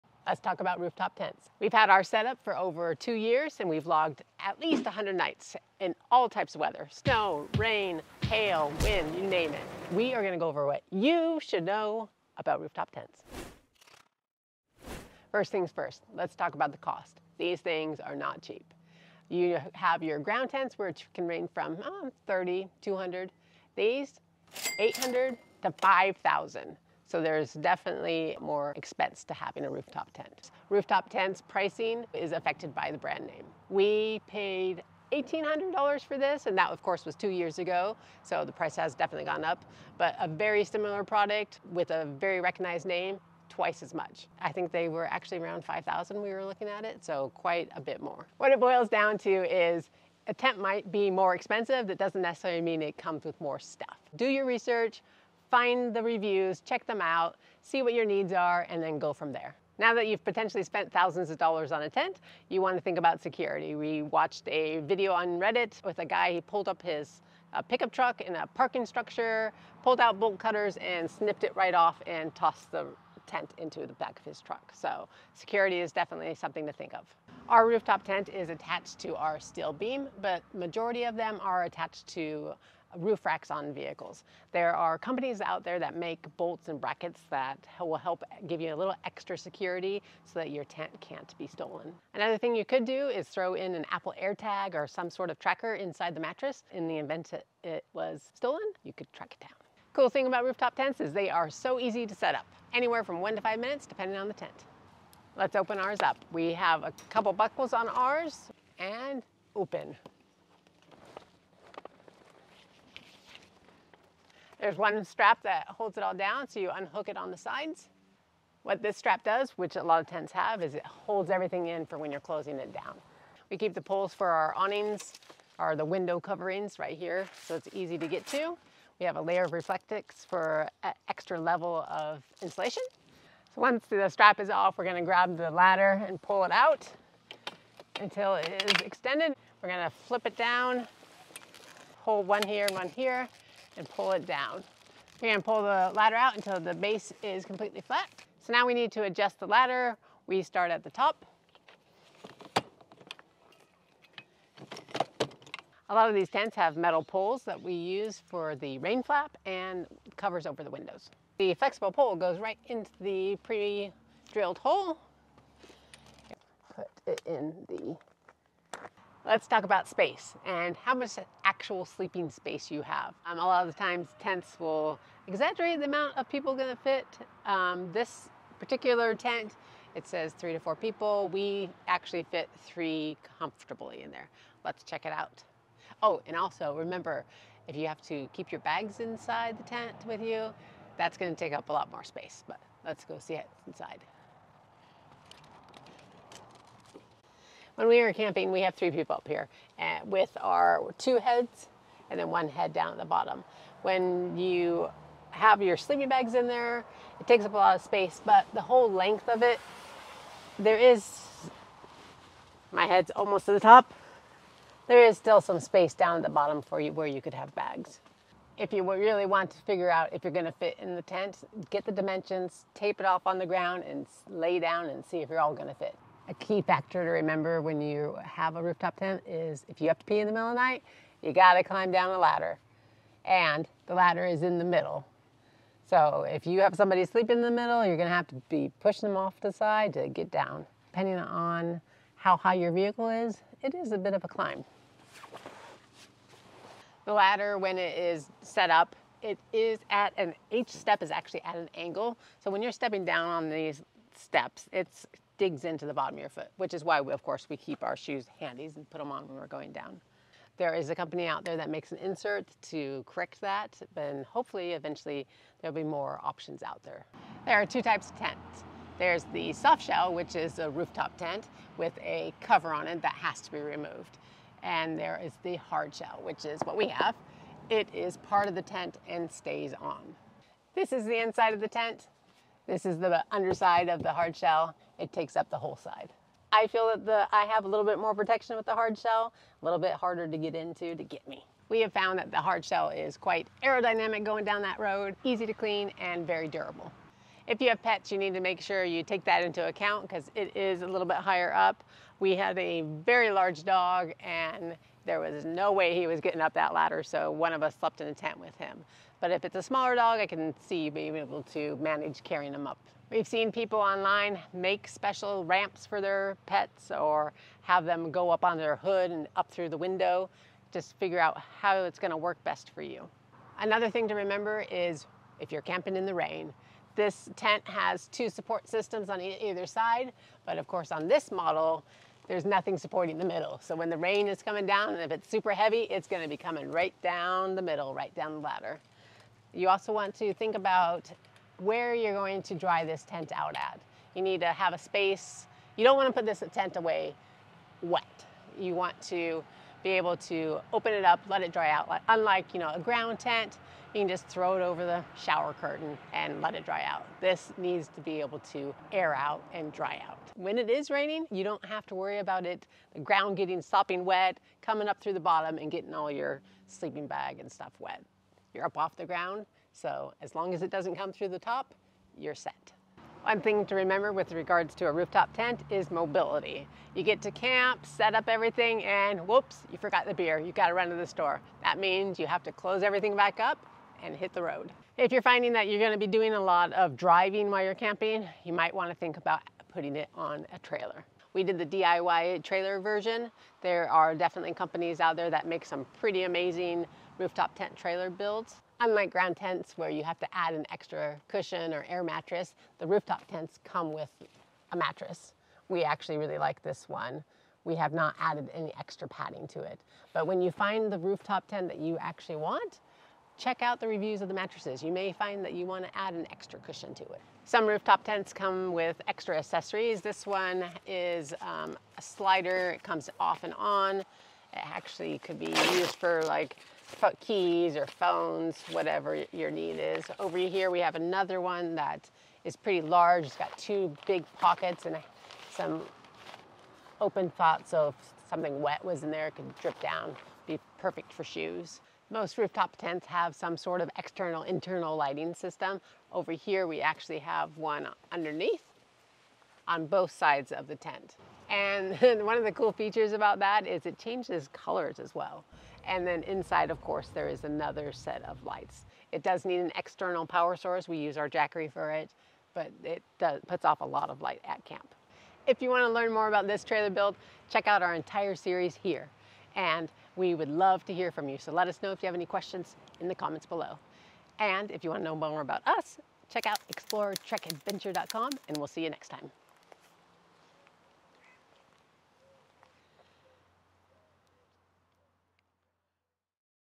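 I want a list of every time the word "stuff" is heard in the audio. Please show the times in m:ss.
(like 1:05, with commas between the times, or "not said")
0:53, 6:07.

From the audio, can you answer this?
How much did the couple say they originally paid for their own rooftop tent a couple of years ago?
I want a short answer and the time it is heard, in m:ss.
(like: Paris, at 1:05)
$1,800, at 0:35.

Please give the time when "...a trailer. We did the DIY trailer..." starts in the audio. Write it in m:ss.
6:30.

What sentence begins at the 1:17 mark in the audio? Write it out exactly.
Our rooftop tent is attached to our steel beam, but majority of them are attached to roof racks on vehicles.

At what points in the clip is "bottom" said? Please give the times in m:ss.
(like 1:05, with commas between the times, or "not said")
3:23, 3:36, 4:15, 6:05.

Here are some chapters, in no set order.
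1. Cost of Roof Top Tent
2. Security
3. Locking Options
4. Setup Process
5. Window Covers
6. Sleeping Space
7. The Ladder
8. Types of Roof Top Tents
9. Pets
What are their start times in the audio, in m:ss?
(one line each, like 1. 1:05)
1. 0:15
2. 1:00
3. 1:25
4. 1:39
5. 2:35
6. 2:49
7. 4:06
8. 4:26
9. 4:57.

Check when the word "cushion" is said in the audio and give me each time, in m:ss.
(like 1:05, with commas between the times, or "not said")
6:41, 6:56.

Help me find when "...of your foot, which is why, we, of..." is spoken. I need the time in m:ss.
4:16.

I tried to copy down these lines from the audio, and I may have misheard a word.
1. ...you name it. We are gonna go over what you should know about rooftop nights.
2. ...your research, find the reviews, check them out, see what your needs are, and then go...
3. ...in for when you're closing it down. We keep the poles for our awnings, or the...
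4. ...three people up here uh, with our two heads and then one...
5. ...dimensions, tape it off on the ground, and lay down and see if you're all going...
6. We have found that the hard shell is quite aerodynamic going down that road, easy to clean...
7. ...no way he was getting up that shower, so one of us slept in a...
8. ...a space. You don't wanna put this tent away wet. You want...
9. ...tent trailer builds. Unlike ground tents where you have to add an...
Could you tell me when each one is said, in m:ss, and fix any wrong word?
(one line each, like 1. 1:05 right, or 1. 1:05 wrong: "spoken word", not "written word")
1. 0:09 wrong: "tents", not "nights"
2. 0:54 right
3. 2:01 right
4. 3:18 right
5. 3:41 right
6. 4:51 right
7. 5:05 wrong: "ladder", not "shower"
8. 5:44 right
9. 6:37 right.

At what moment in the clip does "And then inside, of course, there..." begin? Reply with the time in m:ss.
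7:35.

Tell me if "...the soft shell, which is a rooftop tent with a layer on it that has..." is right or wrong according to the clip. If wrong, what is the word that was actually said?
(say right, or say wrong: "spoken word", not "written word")
wrong: "cover", not "layer".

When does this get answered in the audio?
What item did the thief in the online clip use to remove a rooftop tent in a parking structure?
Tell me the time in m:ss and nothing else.
1:10.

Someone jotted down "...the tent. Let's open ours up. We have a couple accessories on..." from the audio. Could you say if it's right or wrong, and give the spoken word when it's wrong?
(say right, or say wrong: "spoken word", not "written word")
wrong: "buckles", not "accessories".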